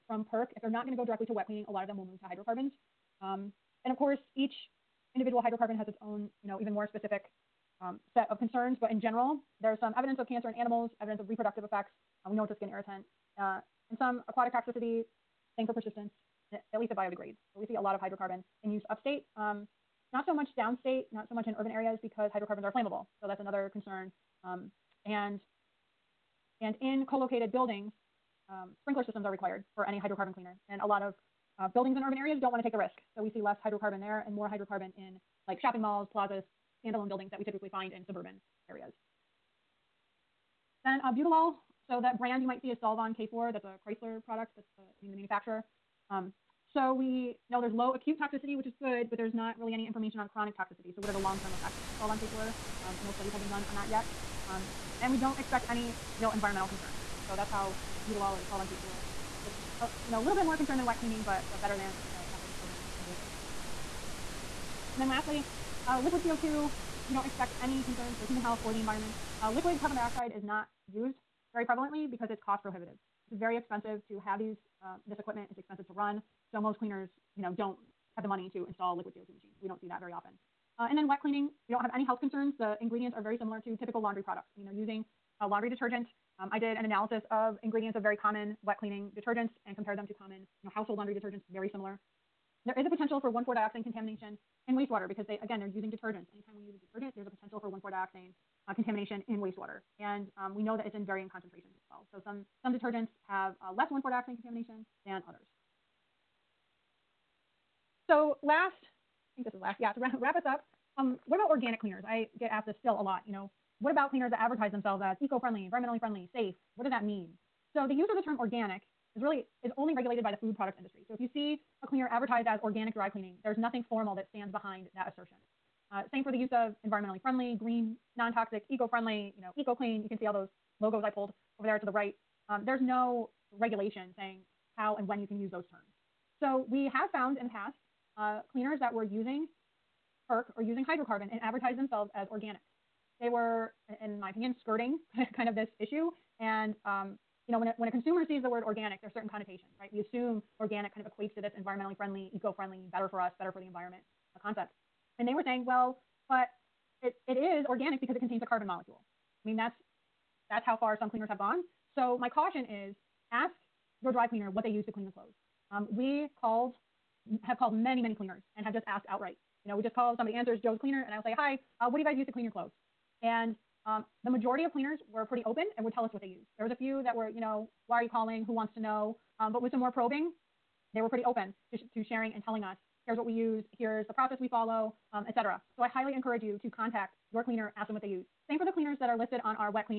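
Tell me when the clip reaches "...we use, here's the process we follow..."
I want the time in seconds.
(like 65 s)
183 s.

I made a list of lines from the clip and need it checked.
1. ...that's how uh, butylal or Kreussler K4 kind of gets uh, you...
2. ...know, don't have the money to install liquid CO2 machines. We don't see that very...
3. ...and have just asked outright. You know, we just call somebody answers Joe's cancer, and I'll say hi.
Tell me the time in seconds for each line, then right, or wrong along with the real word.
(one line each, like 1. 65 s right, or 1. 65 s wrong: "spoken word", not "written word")
1. 57 s wrong: "Solvon", not "Kreussler"
2. 77 s right
3. 168 s wrong: "cleaner", not "cancer".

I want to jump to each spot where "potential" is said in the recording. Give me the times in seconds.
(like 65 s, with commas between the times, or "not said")
92 s, 97 s.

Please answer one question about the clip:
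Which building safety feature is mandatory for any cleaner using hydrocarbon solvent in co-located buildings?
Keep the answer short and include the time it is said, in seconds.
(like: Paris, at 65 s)
Sprinkler systems, at 28 s.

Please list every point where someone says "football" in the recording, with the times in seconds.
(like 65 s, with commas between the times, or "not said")
not said.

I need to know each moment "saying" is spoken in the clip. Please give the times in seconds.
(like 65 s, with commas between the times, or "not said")
134 s, 155 s.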